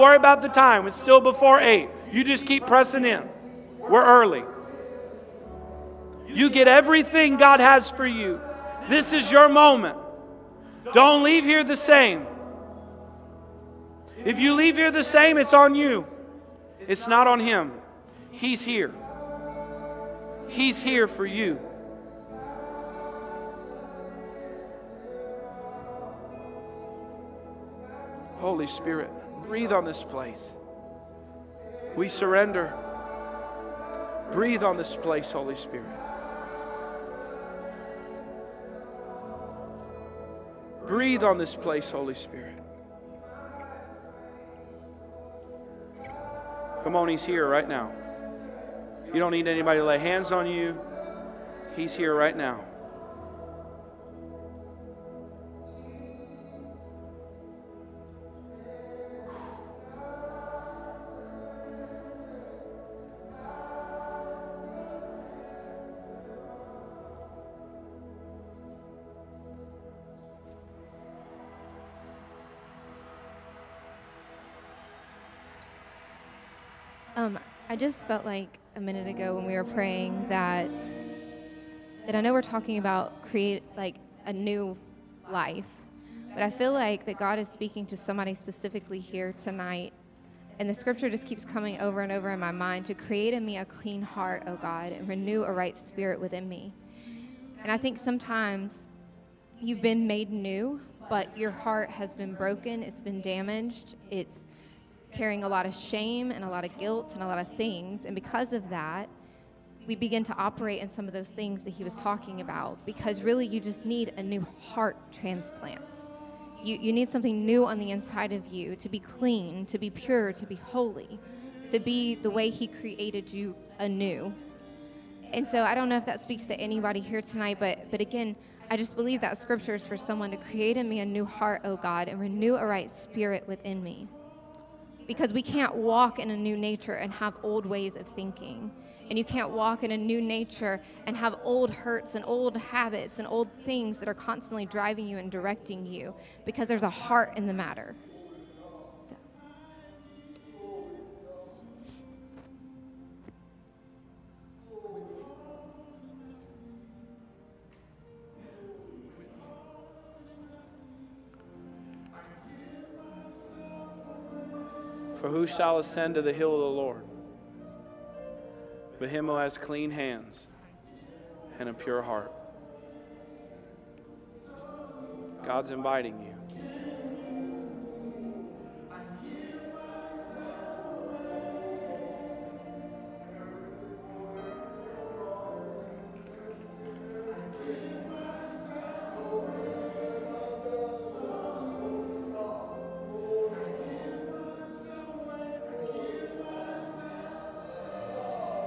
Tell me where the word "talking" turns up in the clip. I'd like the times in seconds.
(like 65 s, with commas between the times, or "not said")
82 s, 111 s.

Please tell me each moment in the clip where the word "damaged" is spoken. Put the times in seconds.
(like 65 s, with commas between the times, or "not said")
103 s.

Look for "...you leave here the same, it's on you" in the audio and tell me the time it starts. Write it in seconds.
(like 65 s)
14 s.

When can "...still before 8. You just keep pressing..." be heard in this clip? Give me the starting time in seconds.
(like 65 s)
0 s.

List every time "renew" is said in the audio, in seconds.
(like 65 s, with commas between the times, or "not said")
95 s, 132 s.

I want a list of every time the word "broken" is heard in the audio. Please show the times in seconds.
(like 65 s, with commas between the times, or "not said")
102 s.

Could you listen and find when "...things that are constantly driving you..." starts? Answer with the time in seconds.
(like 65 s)
143 s.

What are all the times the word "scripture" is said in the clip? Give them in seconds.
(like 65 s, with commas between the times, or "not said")
90 s, 129 s.